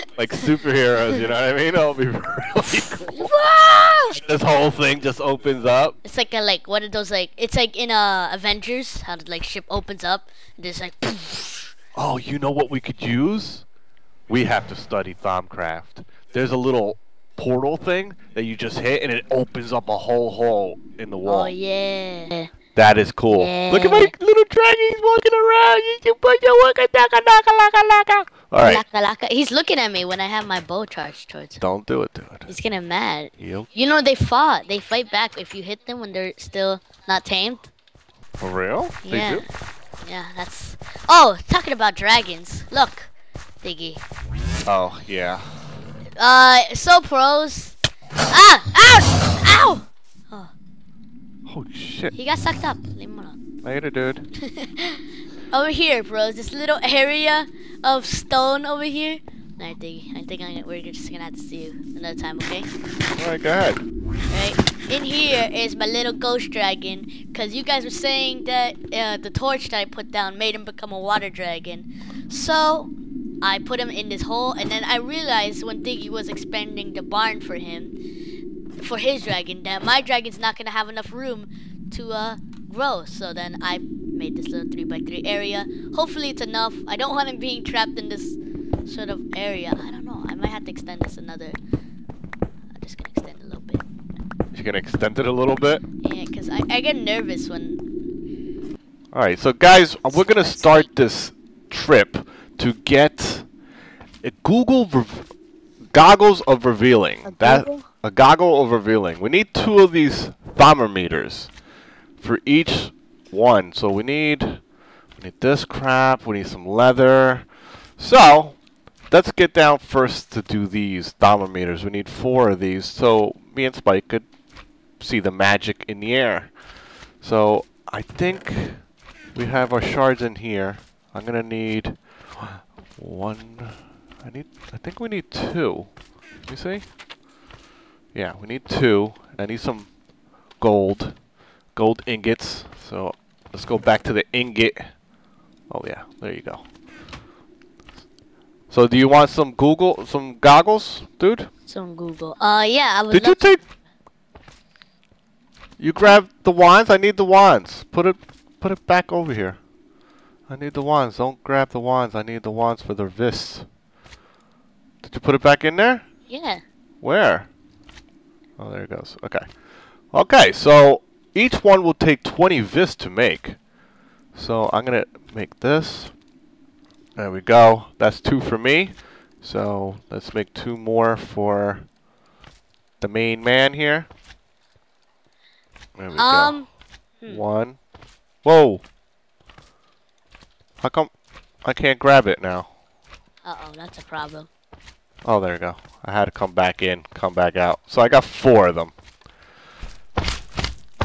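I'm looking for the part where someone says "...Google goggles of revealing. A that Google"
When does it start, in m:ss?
1:44.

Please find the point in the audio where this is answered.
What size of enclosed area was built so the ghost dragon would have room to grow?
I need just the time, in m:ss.
1:24.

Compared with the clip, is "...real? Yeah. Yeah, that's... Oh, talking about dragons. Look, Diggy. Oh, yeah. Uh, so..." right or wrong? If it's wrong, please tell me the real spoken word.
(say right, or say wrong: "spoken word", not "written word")
right.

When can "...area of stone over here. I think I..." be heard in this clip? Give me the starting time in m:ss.
0:56.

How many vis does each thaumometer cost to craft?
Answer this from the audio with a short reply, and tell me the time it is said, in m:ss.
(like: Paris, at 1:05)
20, at 2:52.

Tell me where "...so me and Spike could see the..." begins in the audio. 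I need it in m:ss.
2:02.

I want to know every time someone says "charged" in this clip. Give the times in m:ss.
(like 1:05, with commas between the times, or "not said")
0:30.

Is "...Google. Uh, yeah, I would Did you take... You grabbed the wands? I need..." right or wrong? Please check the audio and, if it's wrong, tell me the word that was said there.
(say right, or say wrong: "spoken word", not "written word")
right.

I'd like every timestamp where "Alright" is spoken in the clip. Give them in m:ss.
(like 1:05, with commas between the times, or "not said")
0:28, 1:39.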